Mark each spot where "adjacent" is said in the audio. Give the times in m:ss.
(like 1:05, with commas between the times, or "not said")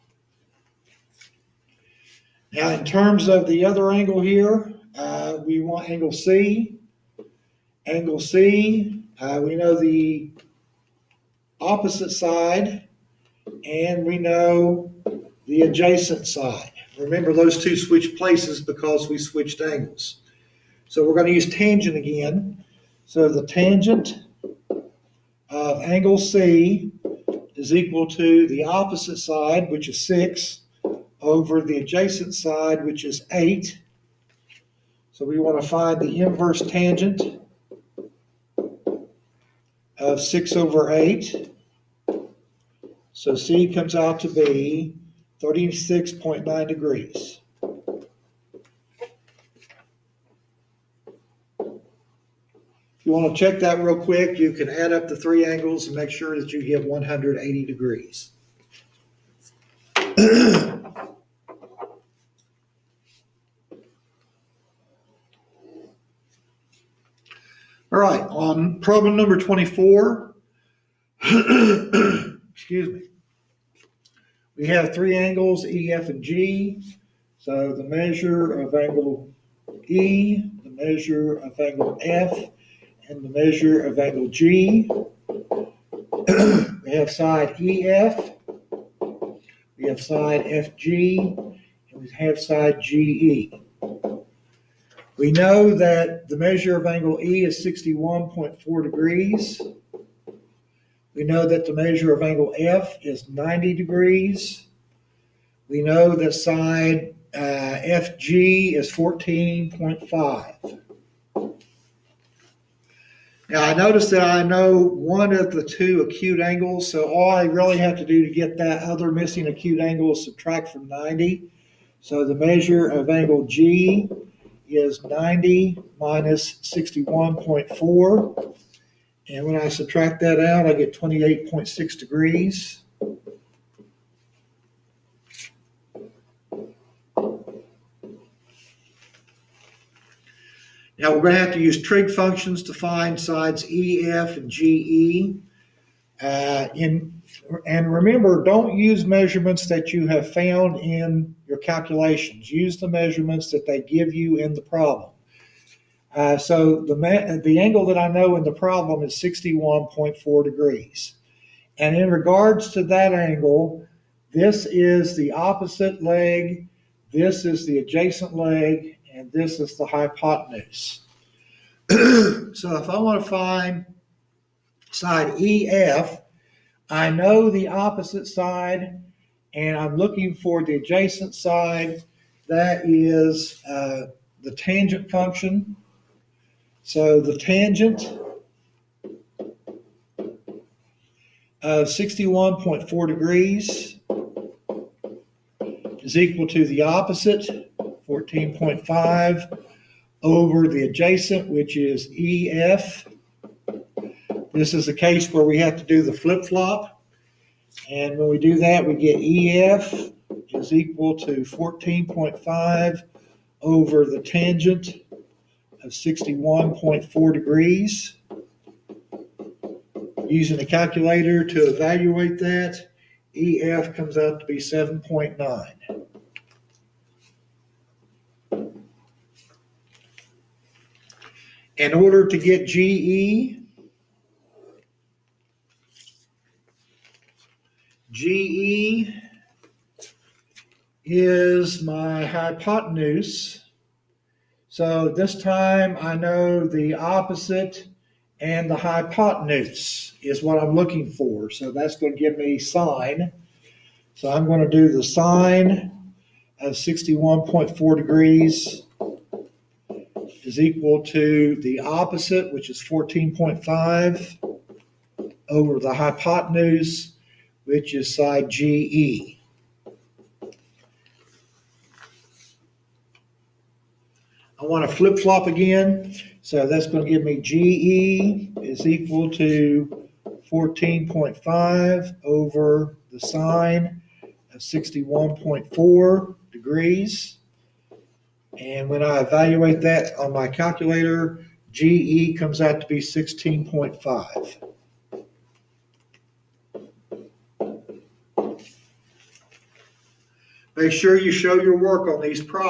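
0:15, 0:31, 2:47, 3:00, 3:20.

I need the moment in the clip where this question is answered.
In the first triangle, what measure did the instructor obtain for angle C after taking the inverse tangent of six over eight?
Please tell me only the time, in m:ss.
0:45.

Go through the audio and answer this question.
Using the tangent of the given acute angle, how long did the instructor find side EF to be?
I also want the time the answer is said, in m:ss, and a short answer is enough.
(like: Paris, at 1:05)
7.9, at 3:44.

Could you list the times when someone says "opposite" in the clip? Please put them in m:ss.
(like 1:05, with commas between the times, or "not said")
0:11, 0:28, 2:45, 2:57, 3:16, 4:06, 4:21.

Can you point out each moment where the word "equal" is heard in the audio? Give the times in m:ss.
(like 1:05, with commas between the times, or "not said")
0:27, 3:16, 3:30, 4:20, 4:38.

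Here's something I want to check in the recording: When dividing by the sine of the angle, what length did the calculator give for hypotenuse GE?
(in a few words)
16.5.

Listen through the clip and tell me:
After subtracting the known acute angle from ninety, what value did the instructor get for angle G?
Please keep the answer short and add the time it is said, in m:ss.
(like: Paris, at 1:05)
28.6 degrees, at 2:10.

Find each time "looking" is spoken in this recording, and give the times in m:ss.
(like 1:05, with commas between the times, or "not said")
2:59, 4:10.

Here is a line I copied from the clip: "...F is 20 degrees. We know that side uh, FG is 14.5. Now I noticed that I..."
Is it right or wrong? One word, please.
wrong.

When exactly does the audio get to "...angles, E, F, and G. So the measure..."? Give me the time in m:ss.
1:15.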